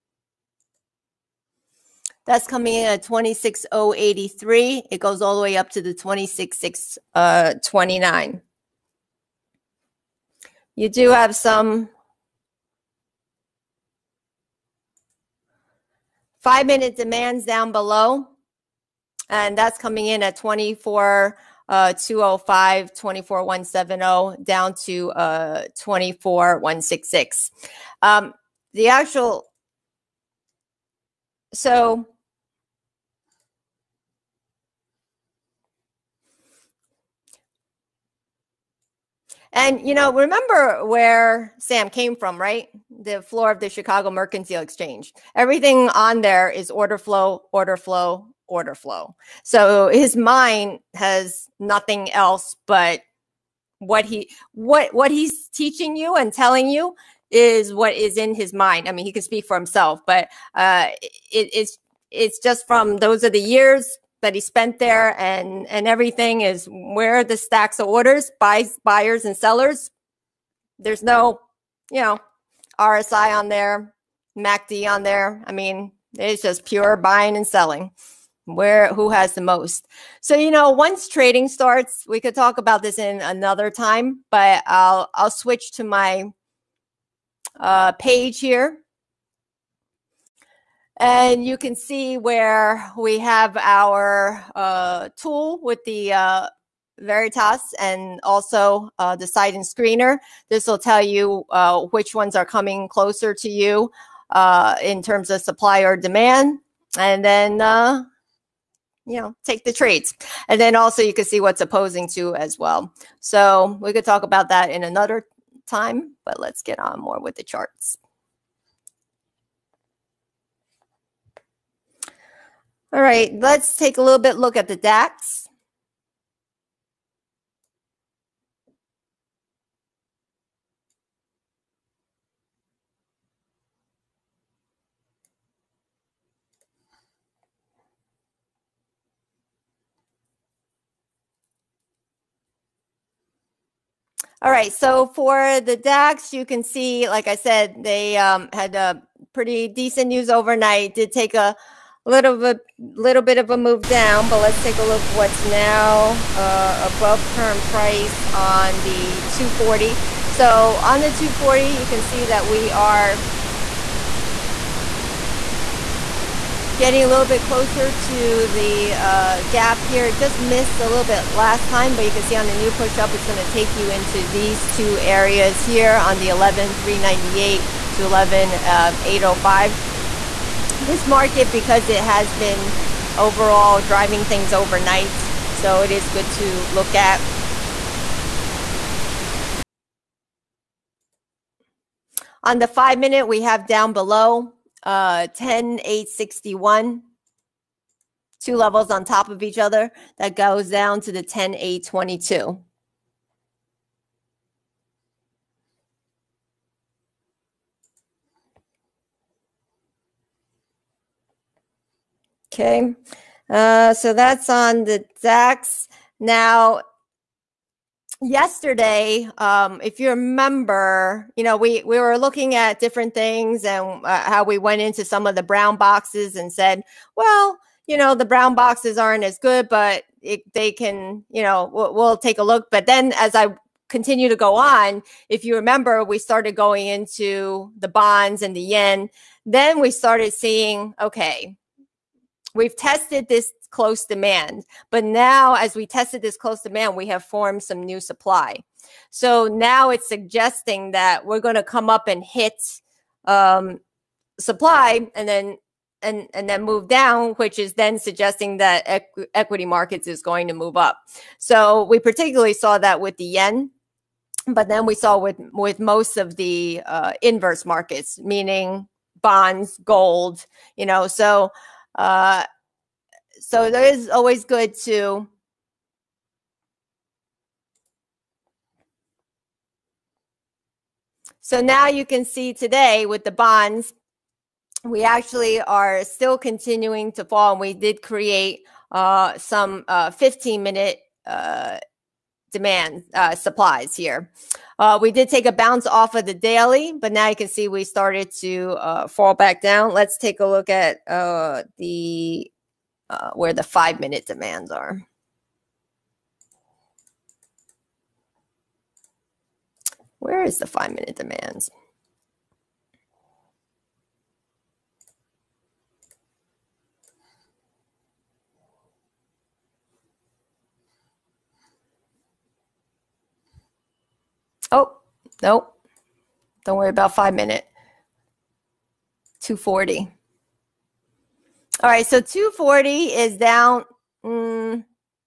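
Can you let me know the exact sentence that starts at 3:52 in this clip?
But then as I continue to go on, if you remember, we started going into the bonds and the yen.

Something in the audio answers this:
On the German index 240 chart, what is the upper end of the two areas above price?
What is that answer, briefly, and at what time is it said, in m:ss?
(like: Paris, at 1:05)
11,805, at 2:58.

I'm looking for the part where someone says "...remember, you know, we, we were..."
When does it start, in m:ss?
3:40.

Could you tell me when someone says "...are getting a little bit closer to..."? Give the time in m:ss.
2:42.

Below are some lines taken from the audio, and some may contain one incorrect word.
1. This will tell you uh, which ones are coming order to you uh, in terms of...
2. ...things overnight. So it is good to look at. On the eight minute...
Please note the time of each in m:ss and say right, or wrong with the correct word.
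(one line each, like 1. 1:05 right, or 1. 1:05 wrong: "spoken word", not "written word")
1. 1:40 wrong: "closer", not "order"
2. 3:04 wrong: "five", not "eight".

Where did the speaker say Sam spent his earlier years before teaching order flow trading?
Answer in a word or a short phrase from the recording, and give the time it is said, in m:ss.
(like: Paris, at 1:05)
Chicago Mercantile Exchange, at 0:43.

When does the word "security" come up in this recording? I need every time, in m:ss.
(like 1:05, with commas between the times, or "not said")
not said.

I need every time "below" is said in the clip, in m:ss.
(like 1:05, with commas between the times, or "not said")
0:17, 3:13.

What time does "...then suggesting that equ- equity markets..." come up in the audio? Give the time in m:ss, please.
4:17.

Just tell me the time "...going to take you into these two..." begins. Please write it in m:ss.
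2:53.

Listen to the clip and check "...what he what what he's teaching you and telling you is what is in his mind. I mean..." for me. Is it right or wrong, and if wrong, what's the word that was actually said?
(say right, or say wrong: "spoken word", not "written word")
right.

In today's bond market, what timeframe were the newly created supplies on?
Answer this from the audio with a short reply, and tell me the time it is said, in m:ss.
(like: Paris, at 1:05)
15 minute, at 4:50.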